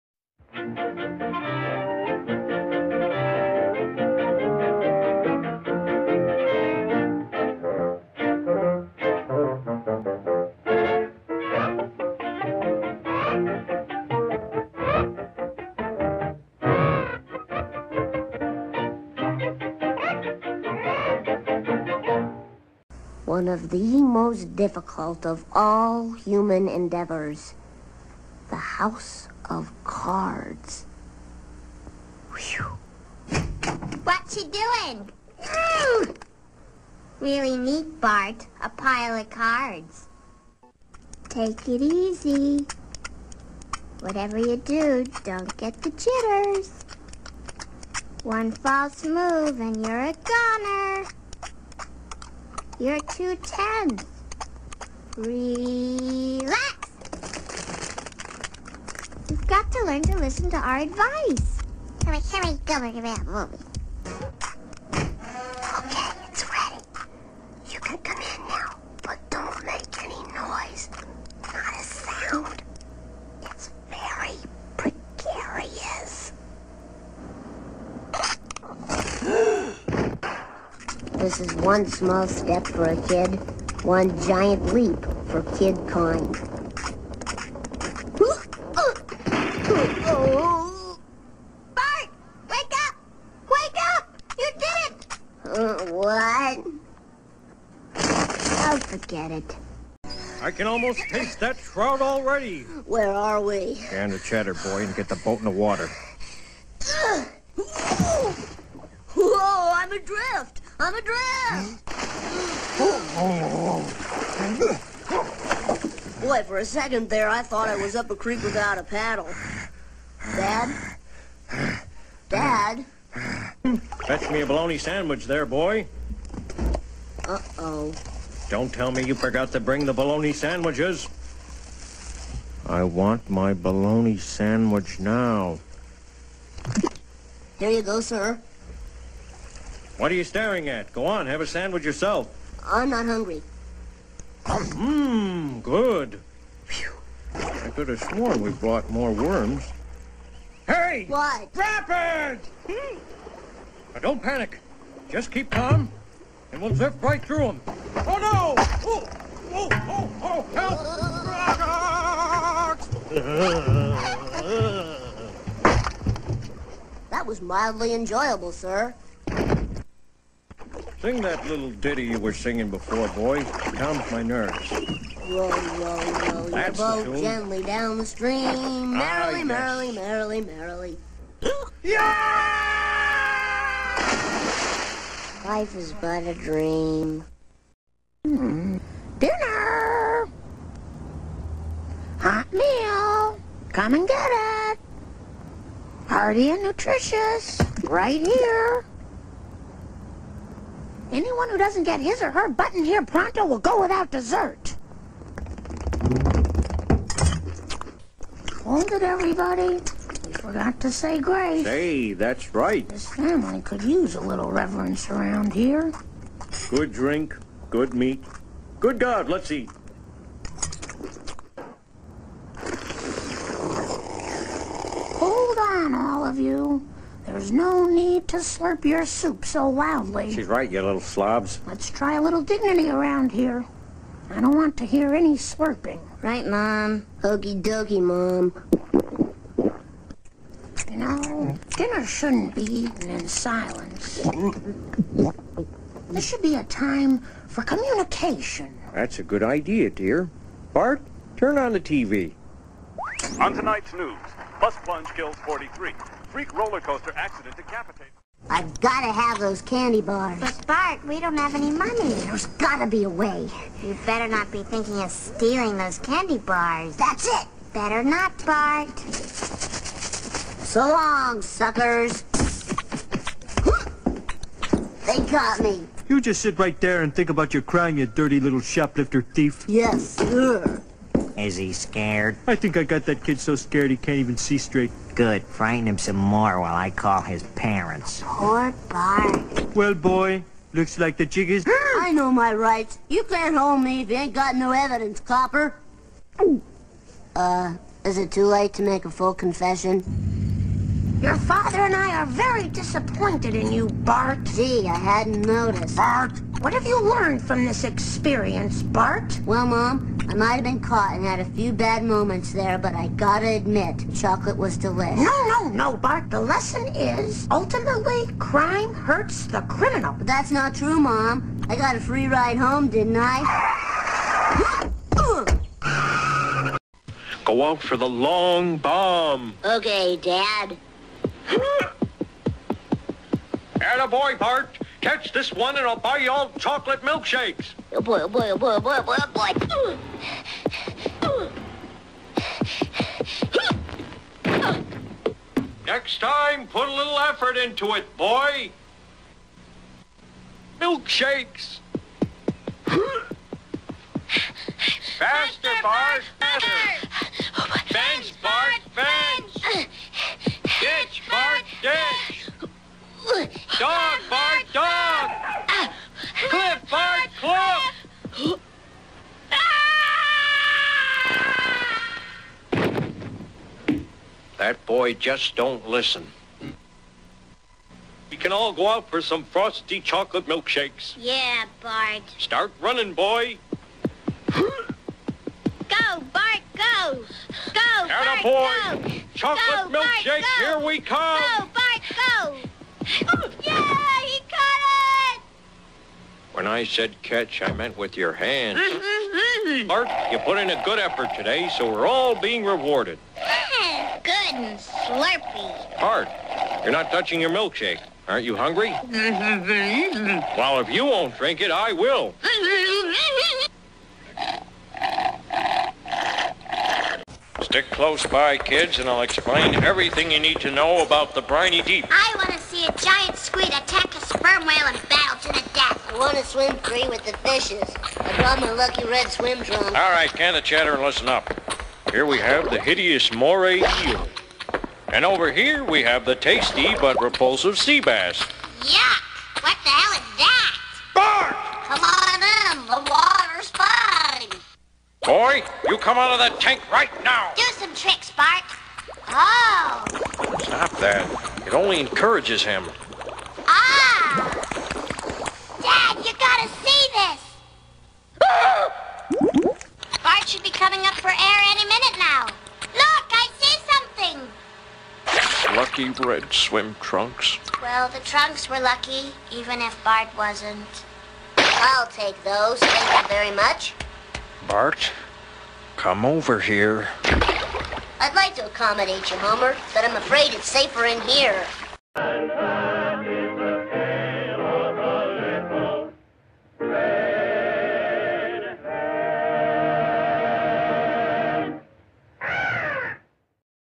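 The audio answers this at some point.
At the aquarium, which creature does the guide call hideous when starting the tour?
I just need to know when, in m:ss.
7:13.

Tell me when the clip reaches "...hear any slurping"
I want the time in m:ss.
3:54.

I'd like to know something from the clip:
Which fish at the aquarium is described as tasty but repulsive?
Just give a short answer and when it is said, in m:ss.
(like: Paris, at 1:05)
Sea bass, at 7:17.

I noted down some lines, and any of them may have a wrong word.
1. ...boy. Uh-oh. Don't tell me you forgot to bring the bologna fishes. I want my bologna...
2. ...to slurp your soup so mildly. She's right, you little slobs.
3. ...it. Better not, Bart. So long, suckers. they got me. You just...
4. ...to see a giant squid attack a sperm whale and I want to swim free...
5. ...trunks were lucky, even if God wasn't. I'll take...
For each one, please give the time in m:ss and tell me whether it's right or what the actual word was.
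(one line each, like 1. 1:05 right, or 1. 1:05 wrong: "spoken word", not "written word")
1. 2:05 wrong: "sandwiches", not "fishes"
2. 3:48 wrong: "loudly", not "mildly"
3. 4:27 right
4. 7:02 right
5. 7:48 wrong: "Bart", not "God".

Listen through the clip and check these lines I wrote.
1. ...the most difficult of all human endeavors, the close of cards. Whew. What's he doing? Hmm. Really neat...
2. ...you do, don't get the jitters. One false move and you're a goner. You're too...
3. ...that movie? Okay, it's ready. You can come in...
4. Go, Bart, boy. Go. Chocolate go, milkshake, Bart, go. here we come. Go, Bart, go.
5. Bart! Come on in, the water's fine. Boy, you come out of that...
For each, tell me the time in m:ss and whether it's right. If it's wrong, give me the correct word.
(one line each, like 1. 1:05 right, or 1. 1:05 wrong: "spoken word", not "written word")
1. 0:23 wrong: "house", not "close"
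2. 0:44 right
3. 1:03 right
4. 6:27 right
5. 7:21 right.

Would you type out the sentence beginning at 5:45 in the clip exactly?
Next time, put a little effort into it, boy.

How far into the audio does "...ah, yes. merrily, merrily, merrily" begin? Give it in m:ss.
2:59.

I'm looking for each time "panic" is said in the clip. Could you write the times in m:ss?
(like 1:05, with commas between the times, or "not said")
2:34.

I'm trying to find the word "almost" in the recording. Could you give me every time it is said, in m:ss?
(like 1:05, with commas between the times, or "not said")
1:40.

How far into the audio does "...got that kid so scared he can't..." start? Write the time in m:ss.
4:42.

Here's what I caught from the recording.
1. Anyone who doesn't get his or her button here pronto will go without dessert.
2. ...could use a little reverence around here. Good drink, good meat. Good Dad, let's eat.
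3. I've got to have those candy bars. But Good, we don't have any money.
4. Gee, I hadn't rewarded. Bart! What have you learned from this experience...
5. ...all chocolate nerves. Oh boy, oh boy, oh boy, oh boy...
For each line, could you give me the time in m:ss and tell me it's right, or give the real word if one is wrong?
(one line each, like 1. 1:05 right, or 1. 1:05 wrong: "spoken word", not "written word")
1. 3:21 right
2. 3:33 wrong: "God", not "Dad"
3. 4:18 wrong: "Bart", not "Good"
4. 5:04 wrong: "noticed", not "rewarded"
5. 5:36 wrong: "milkshakes", not "nerves".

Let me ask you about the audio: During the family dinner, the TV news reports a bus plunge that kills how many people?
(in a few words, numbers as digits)
43.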